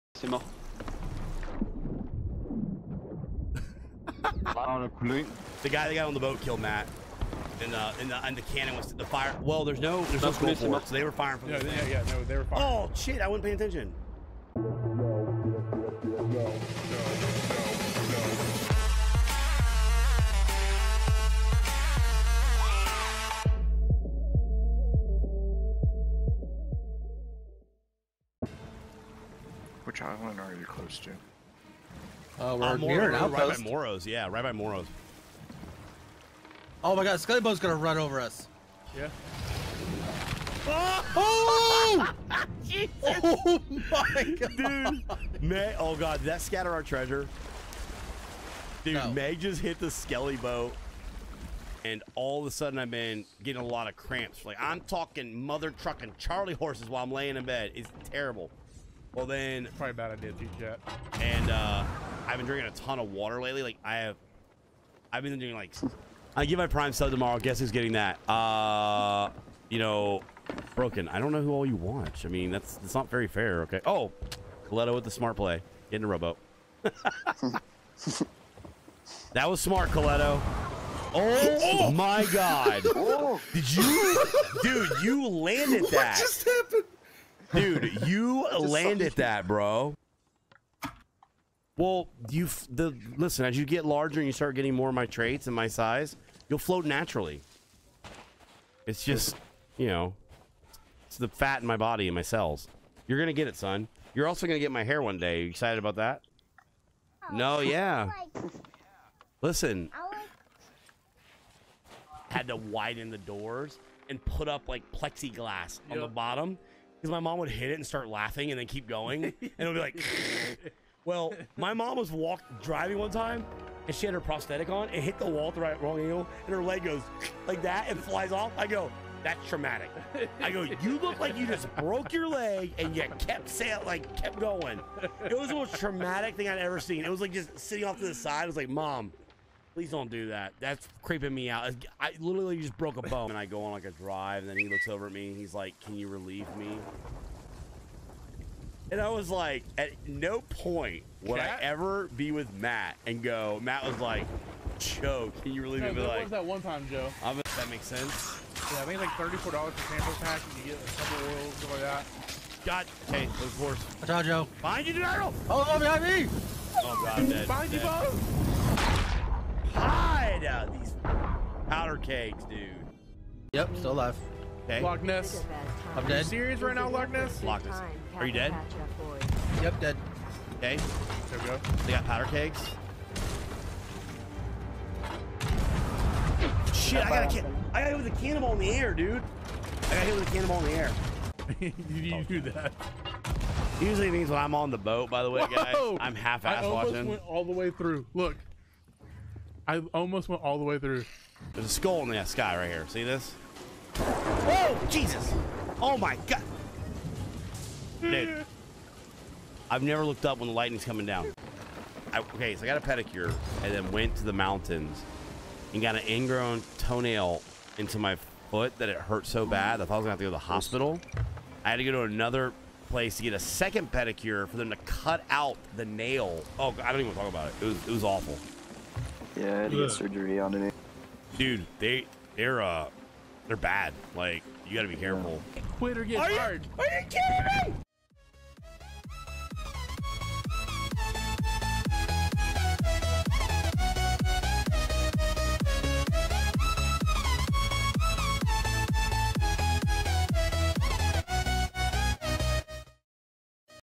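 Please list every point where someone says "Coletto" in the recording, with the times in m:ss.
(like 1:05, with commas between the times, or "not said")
1:14, 1:19.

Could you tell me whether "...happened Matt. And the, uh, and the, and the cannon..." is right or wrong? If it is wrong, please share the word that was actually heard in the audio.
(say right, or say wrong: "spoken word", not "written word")
wrong: "killed", not "happened".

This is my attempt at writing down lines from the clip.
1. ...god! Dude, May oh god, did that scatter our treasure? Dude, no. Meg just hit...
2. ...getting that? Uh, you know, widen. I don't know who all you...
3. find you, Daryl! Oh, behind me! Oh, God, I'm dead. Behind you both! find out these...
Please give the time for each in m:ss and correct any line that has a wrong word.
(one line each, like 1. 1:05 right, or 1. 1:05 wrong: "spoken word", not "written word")
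1. 0:44 right
2. 1:07 wrong: "broken", not "widen"
3. 2:44 right.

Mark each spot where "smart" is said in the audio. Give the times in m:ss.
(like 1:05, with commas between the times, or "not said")
1:15, 1:19.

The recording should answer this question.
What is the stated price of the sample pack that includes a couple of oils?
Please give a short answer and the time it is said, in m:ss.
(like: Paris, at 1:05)
$34, at 2:39.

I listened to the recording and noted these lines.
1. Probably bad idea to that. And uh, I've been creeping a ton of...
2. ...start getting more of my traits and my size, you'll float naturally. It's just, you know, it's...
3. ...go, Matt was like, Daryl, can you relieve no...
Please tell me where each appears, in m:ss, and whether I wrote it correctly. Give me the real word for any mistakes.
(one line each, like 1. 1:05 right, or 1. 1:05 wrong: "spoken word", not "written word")
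1. 0:59 wrong: "drinking", not "creeping"
2. 1:34 right
3. 2:33 wrong: "Joe", not "Daryl".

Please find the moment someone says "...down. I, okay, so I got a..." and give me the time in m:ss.
3:31.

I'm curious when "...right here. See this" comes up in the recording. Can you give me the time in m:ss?
3:22.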